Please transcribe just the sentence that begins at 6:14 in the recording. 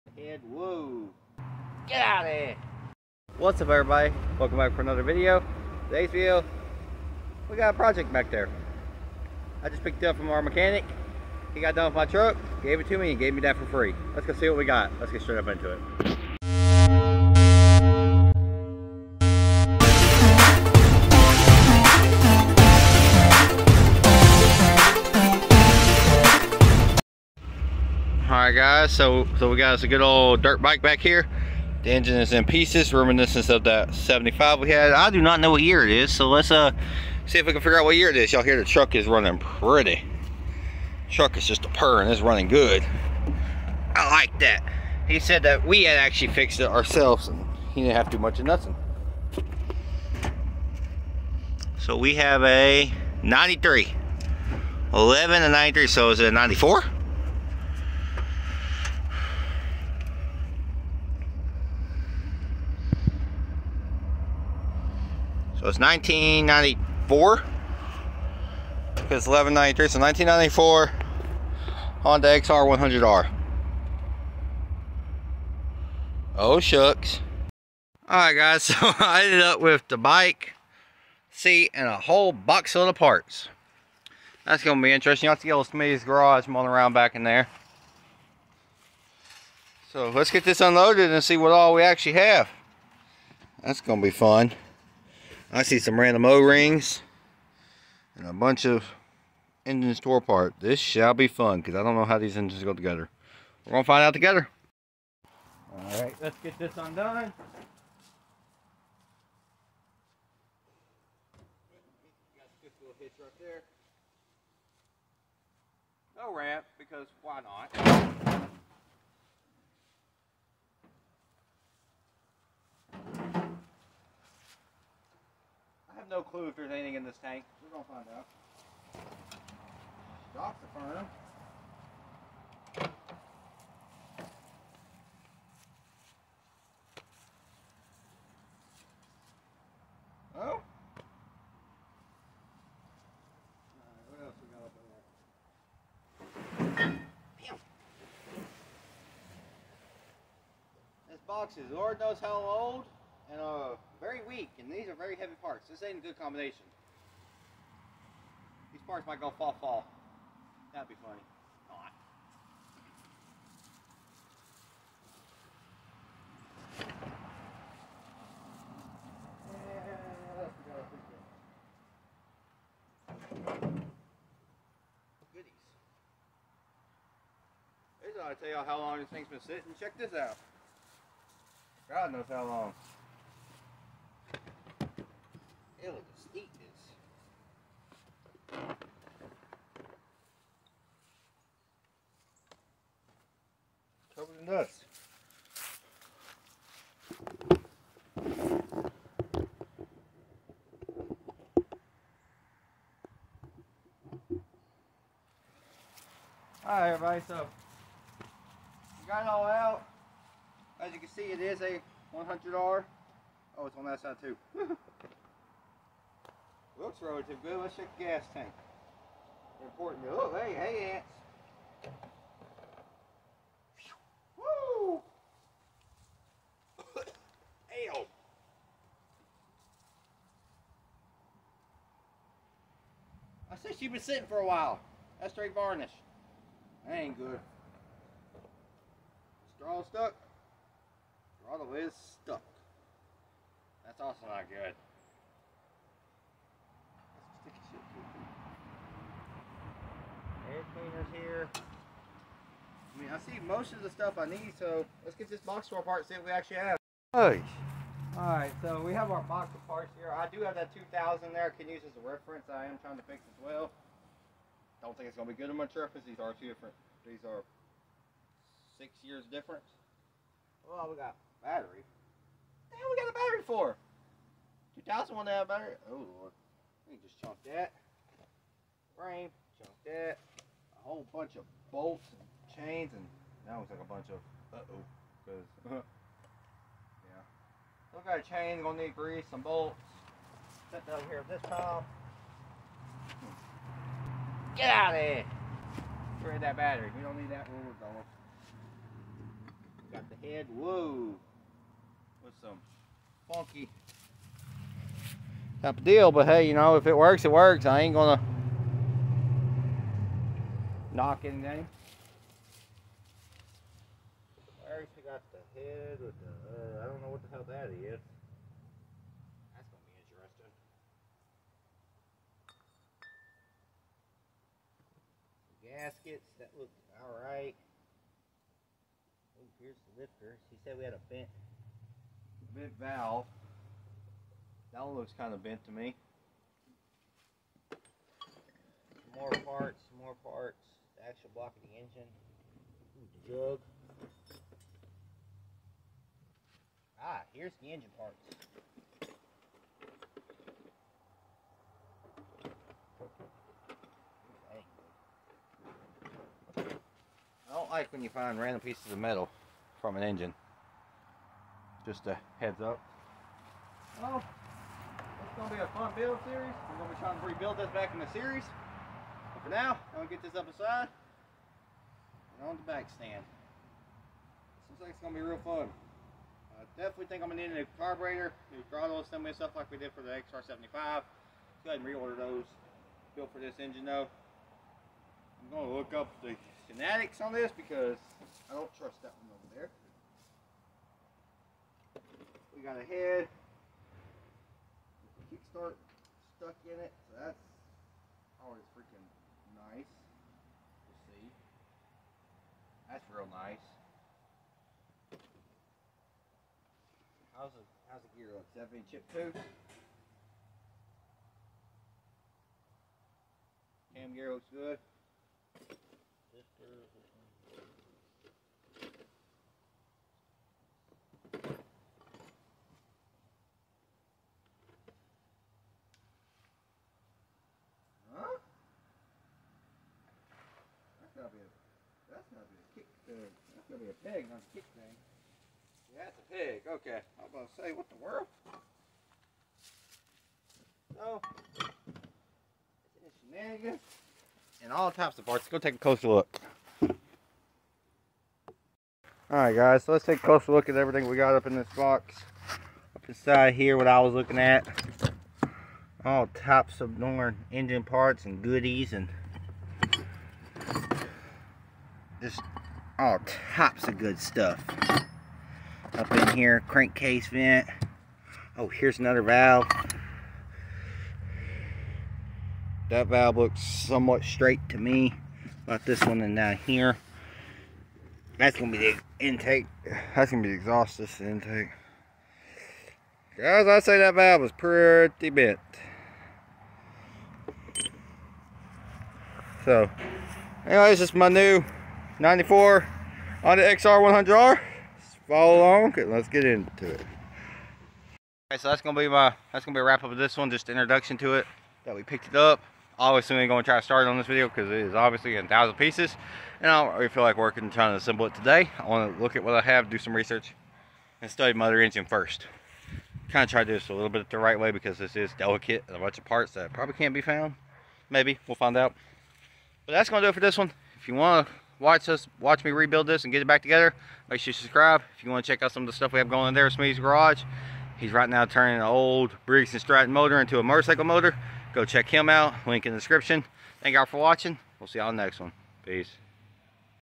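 Seems like it's going to be real fun.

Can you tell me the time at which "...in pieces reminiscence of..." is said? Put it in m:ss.
0:32.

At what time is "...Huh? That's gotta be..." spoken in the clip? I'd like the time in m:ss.
7:08.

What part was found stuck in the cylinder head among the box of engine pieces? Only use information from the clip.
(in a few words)
kickstart.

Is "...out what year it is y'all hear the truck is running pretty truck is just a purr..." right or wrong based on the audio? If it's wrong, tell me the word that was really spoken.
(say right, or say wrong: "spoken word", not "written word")
right.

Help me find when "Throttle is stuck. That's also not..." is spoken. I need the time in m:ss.
4:01.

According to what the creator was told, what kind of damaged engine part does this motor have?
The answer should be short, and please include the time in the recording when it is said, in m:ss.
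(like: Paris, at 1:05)
bent valve, at 5:31.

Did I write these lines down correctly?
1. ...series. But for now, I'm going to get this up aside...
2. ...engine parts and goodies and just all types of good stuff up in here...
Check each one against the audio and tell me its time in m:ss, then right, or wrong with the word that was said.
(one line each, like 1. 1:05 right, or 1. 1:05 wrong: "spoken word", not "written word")
1. 6:08 right
2. 7:37 right.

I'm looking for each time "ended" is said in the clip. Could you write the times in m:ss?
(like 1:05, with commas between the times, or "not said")
1:19.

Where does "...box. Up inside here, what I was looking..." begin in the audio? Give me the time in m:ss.
7:31.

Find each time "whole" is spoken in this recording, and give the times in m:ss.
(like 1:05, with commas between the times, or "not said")
1:21, 4:40.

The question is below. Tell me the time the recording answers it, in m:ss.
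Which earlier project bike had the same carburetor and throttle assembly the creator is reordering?
6:20.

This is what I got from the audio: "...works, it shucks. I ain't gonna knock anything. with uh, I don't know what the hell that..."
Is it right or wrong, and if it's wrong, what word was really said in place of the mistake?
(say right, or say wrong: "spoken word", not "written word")
wrong: "works", not "shucks".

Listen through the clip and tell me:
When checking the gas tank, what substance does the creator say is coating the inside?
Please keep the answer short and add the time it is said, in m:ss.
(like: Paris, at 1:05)
varnish, at 3:55.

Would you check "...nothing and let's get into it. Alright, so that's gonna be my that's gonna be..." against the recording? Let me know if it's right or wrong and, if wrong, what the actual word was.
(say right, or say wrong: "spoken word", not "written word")
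wrong: "along", not "nothing".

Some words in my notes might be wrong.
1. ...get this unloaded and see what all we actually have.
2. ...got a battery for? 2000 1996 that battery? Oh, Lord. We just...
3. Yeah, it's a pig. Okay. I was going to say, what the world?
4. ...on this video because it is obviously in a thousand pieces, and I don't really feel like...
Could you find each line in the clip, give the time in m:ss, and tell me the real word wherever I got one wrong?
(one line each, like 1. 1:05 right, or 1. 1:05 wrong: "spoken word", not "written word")
1. 1:30 right
2. 4:32 wrong: "2001", not "1996"
3. 7:15 right
4. 8:24 right.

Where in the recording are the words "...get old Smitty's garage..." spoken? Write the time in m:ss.
1:25.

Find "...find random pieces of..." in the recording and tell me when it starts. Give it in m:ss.
5:58.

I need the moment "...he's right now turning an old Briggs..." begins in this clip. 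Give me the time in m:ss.
8:47.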